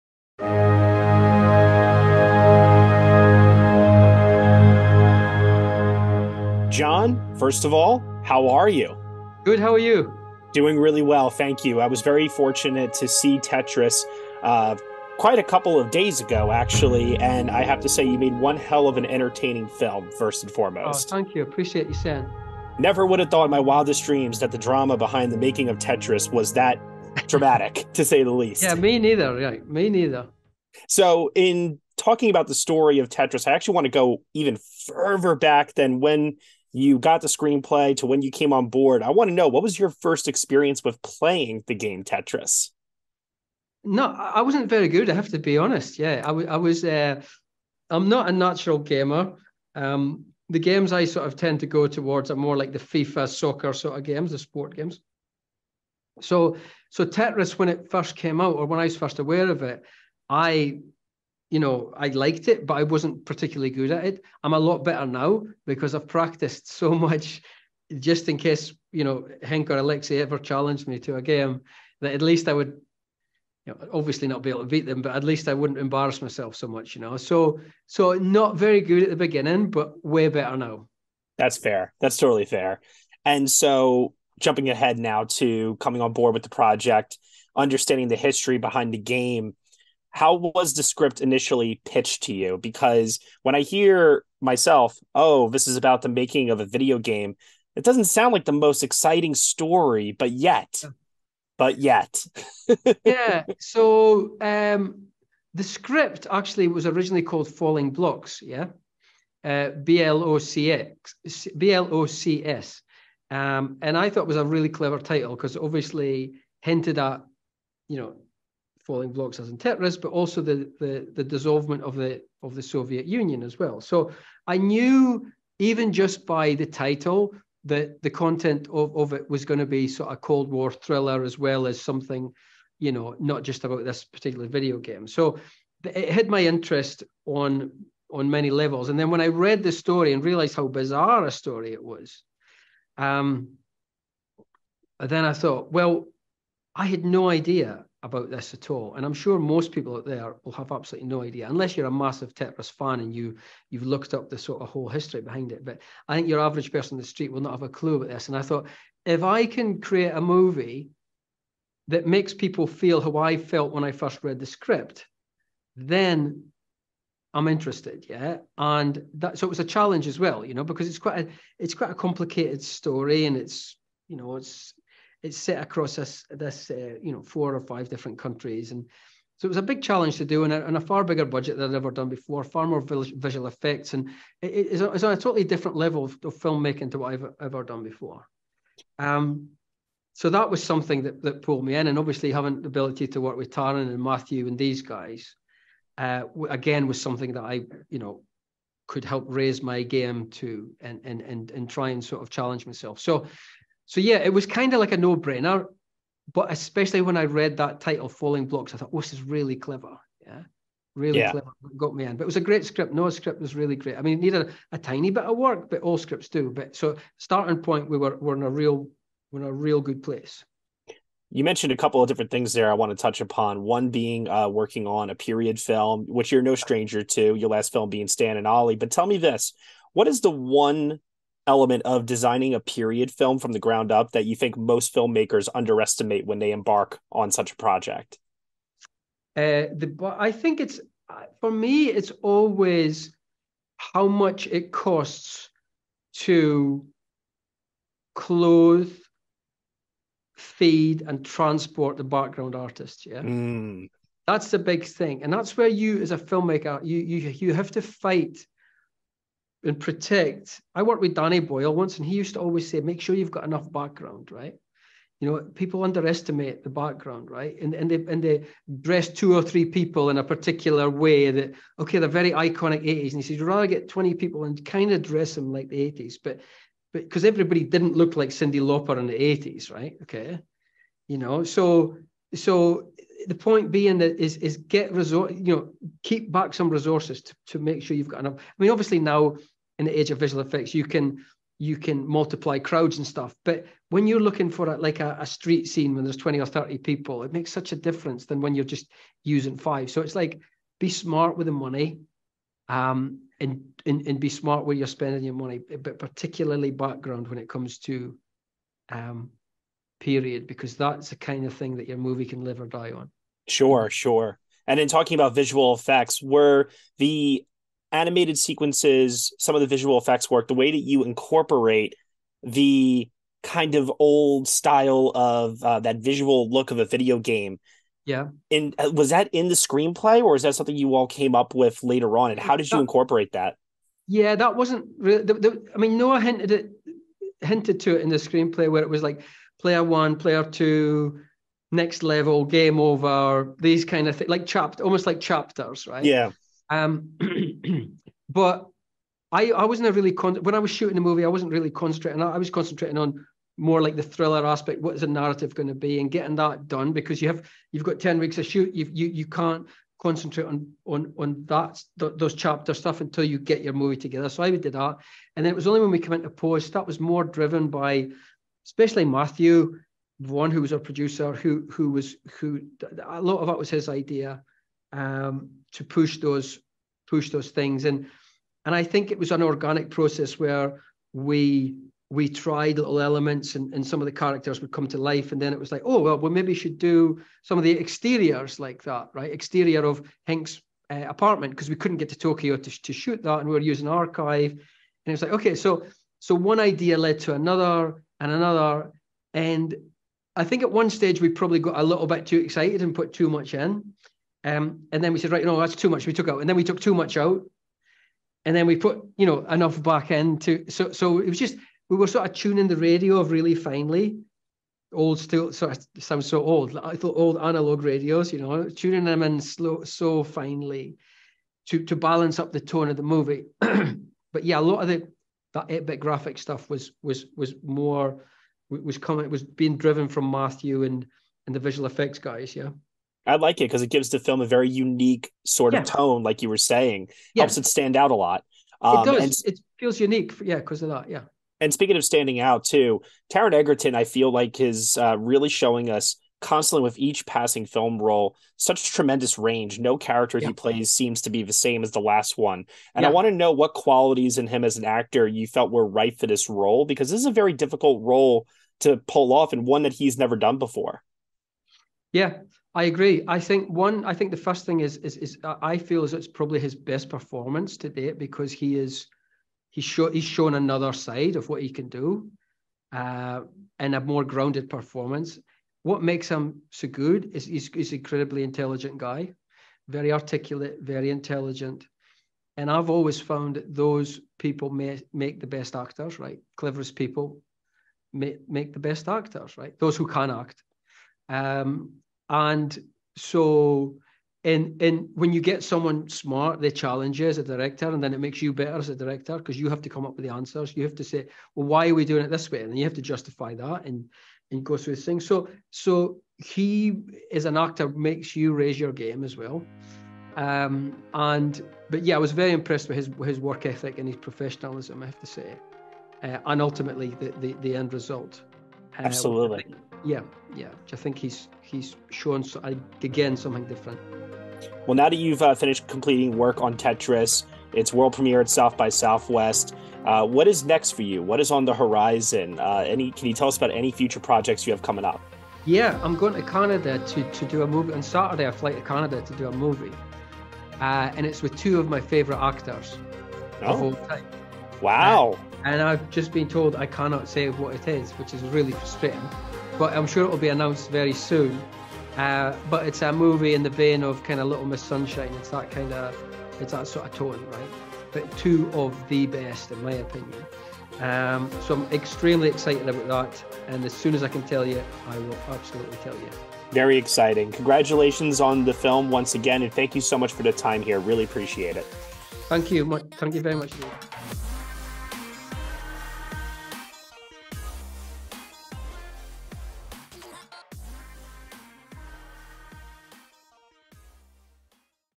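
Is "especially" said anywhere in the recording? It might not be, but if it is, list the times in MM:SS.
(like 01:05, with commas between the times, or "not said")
03:26, 06:08.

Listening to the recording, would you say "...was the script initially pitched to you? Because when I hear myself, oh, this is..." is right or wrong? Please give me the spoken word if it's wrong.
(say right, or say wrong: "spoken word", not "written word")
right.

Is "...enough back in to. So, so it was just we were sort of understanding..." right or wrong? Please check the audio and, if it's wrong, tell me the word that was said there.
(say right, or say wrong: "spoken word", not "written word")
wrong: "tuning", not "understanding".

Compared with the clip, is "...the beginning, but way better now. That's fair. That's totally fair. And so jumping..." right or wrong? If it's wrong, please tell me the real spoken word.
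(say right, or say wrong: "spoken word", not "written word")
right.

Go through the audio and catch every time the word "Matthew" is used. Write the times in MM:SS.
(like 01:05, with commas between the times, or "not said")
03:14, 06:09, 07:10.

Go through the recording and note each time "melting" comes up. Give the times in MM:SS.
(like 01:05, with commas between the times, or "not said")
not said.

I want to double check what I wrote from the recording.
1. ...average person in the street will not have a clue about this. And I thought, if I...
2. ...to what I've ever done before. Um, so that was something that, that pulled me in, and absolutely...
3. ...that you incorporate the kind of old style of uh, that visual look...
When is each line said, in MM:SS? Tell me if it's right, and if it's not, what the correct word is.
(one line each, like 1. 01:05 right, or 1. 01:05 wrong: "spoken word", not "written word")
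1. 02:36 right
2. 03:06 wrong: "obviously", not "absolutely"
3. 05:20 right.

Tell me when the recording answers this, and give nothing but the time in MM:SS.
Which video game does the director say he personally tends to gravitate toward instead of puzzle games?
00:52.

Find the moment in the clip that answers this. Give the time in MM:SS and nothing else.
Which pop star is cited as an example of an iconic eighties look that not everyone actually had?
04:38.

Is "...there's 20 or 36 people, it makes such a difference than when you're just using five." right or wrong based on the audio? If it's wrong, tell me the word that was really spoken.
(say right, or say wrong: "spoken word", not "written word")
wrong: "30", not "36".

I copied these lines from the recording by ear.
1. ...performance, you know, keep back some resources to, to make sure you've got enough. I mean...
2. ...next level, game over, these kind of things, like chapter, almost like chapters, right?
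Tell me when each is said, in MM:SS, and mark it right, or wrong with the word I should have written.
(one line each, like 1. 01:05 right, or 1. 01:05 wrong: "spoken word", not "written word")
1. 04:44 wrong: "resource", not "performance"
2. 05:41 right.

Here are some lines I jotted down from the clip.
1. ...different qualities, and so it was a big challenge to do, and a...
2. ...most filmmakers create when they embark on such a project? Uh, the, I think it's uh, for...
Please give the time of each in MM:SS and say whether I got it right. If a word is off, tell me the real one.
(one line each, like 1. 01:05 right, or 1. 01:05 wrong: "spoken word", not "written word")
1. 02:57 wrong: "countries", not "qualities"
2. 03:54 wrong: "underestimate", not "create".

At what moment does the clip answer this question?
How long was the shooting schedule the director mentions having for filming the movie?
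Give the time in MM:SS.
05:57.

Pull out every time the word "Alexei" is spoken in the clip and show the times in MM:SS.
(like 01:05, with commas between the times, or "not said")
01:09.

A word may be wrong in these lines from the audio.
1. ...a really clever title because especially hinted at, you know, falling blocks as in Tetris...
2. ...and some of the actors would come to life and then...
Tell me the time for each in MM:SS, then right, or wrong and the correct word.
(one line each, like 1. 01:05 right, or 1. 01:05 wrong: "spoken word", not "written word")
1. 01:54 wrong: "obviously", not "especially"
2. 06:23 wrong: "characters", not "actors".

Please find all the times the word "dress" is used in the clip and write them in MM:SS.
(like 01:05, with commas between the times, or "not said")
04:28, 04:35.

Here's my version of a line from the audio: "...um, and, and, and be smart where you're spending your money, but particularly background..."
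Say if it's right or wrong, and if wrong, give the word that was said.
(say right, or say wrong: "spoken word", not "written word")
right.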